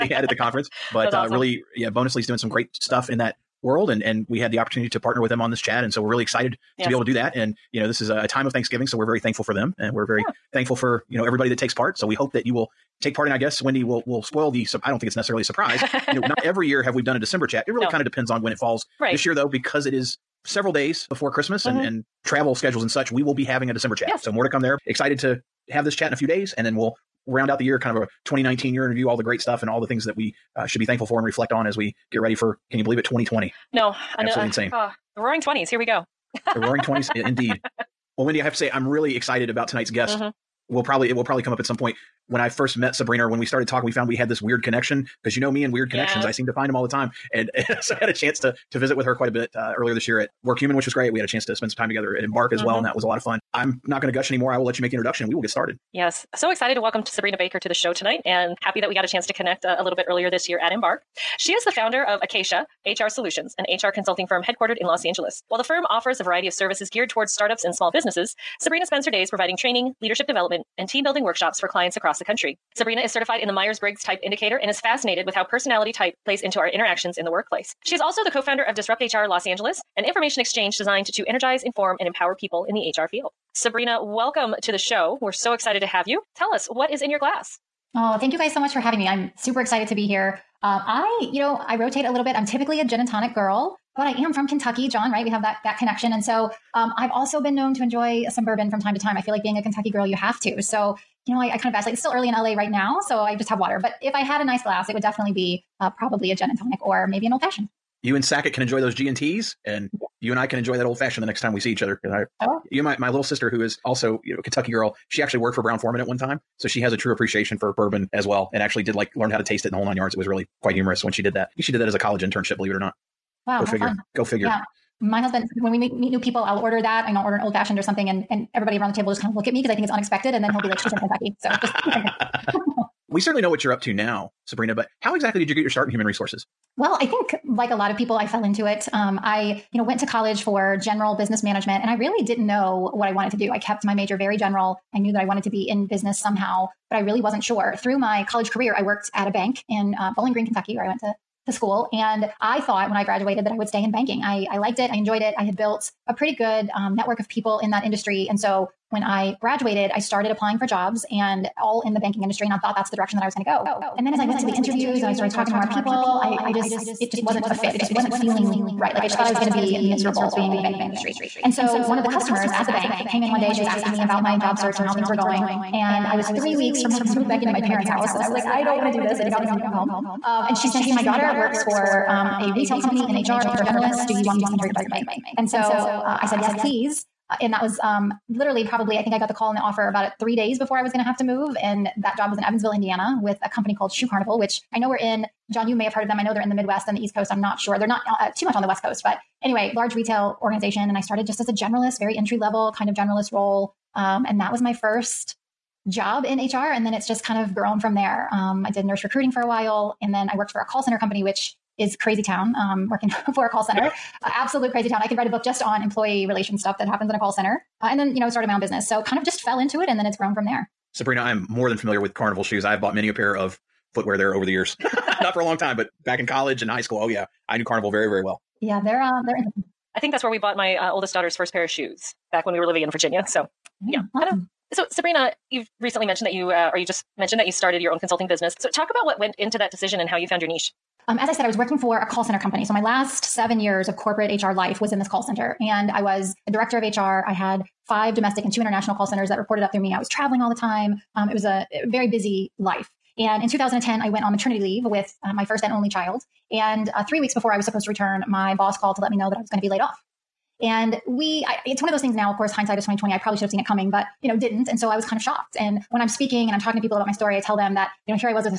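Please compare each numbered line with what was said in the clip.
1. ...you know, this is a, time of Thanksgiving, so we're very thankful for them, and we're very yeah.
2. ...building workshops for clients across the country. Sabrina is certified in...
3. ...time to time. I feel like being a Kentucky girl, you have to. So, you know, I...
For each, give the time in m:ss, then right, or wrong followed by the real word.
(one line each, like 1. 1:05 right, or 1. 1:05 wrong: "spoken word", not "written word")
1. 0:07 right
2. 1:11 right
3. 1:38 right.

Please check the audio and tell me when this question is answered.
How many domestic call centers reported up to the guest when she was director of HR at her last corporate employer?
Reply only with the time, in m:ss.
4:07.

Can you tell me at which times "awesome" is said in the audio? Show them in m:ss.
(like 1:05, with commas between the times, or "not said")
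0:01, 3:54.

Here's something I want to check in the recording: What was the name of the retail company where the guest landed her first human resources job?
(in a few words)
Shoe Carnival.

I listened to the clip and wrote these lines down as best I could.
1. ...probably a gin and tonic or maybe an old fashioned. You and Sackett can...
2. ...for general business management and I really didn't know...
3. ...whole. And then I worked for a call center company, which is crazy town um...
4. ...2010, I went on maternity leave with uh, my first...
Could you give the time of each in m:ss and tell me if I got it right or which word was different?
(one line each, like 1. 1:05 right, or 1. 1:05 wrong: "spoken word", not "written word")
1. 1:45 right
2. 2:20 right
3. 3:29 wrong: "while", not "whole"
4. 4:13 right.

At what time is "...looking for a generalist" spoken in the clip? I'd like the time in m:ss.
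3:03.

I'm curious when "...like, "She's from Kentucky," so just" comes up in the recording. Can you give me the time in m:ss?
2:10.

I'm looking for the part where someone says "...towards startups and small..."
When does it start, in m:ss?
1:07.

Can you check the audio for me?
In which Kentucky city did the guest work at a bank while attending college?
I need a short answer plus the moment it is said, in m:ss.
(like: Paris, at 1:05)
Bowling Green, at 2:30.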